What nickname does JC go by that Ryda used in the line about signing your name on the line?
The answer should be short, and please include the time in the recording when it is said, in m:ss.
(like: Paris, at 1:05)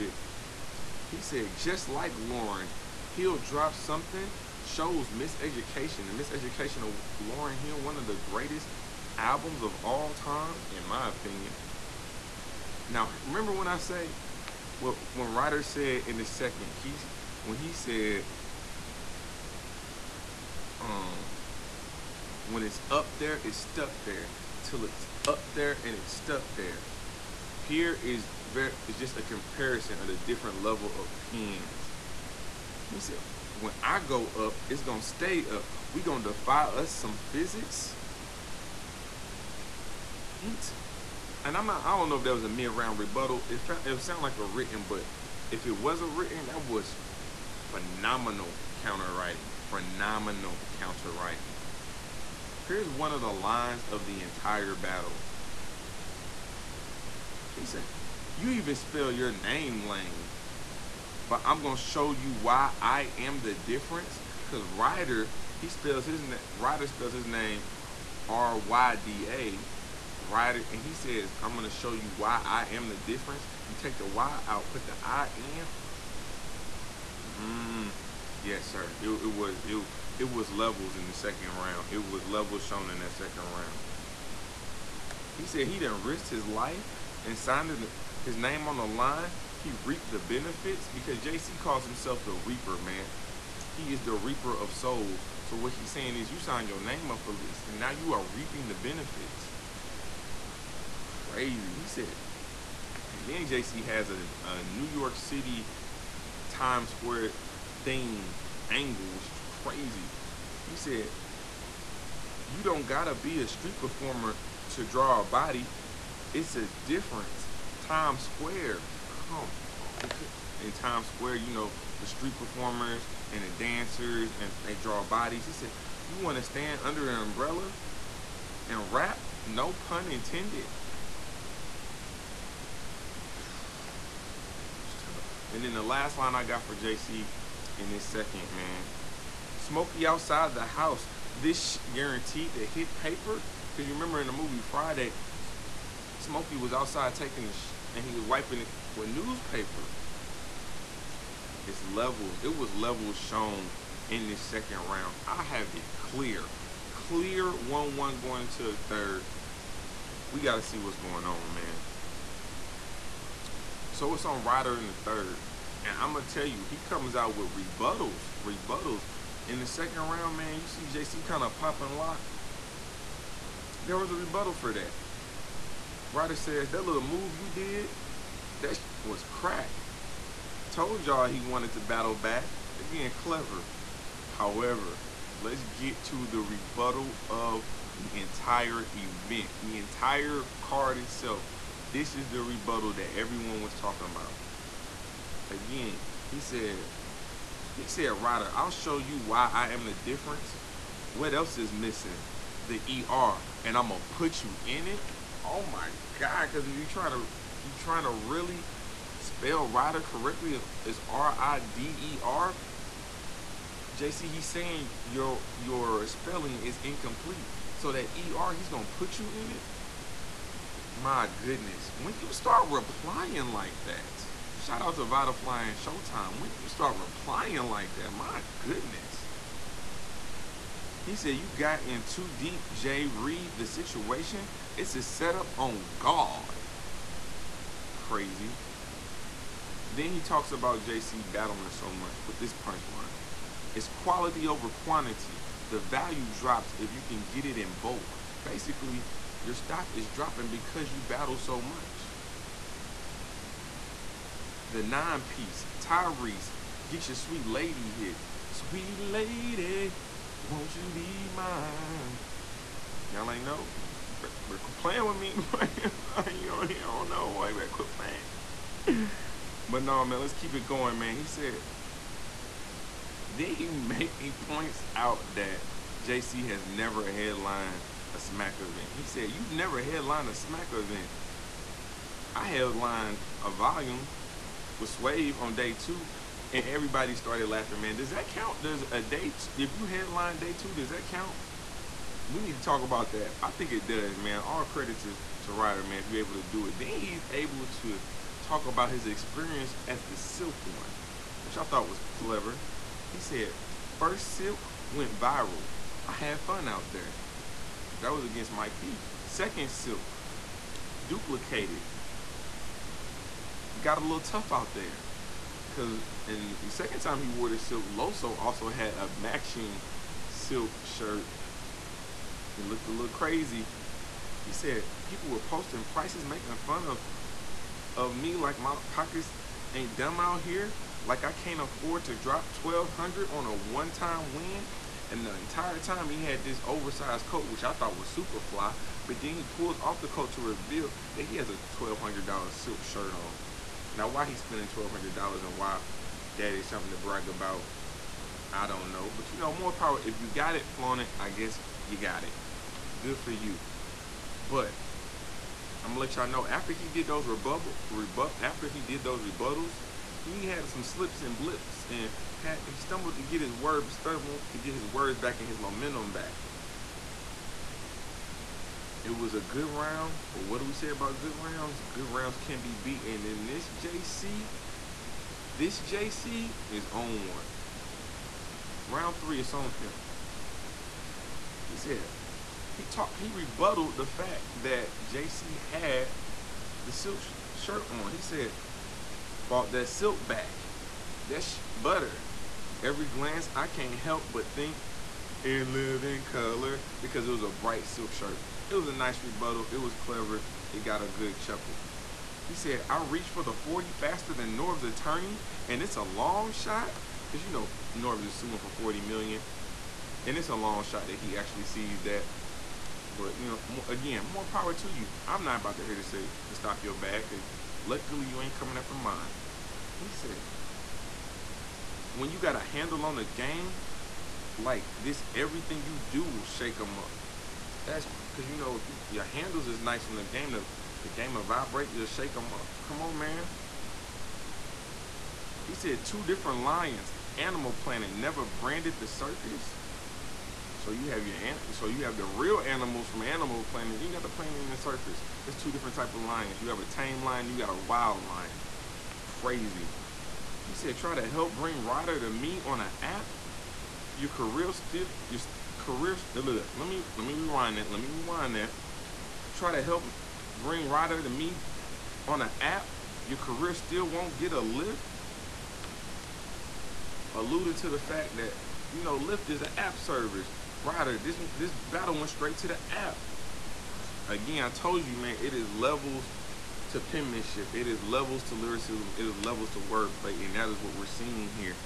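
reaper man, at 1:32.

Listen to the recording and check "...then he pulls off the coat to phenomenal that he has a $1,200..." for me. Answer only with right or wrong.
wrong.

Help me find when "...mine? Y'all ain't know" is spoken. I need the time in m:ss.
4:21.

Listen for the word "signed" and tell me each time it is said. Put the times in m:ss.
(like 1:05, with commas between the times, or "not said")
1:27, 1:36.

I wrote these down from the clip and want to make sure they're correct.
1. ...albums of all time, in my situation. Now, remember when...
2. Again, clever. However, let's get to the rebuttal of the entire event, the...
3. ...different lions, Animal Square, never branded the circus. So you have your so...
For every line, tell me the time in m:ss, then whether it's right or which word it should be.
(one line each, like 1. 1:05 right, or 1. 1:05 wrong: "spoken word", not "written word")
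1. 0:09 wrong: "opinion", not "situation"
2. 3:02 right
3. 7:16 wrong: "Planet", not "Square".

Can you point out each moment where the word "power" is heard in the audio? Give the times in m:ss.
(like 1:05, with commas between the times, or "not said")
5:49, 6:54.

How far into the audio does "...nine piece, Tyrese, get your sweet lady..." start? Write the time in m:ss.
4:14.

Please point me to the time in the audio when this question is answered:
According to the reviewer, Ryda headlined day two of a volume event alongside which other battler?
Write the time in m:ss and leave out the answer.
4:44.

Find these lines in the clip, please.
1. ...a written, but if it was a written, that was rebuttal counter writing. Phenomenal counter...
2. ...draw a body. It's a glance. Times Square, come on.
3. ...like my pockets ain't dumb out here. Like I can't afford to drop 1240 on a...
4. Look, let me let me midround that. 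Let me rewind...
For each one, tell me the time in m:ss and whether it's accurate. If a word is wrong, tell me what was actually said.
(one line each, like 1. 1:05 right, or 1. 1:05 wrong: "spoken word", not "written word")
1. 0:44 wrong: "phenomenal", not "rebuttal"
2. 1:54 wrong: "difference", not "glance"
3. 5:28 wrong: "1200", not "1240"
4. 7:36 wrong: "rewind", not "midround".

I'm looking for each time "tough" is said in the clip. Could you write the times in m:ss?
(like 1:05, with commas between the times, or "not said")
2:14, 5:14.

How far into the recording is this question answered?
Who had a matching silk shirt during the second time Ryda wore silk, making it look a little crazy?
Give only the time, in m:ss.
5:17.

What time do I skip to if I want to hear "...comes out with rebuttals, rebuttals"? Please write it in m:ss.
2:46.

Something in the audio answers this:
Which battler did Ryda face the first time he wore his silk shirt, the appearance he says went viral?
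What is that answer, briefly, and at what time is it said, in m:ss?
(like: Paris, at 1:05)
Mike P, at 5:08.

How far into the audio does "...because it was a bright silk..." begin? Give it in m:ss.
6:37.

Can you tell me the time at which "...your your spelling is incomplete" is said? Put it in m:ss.
3:35.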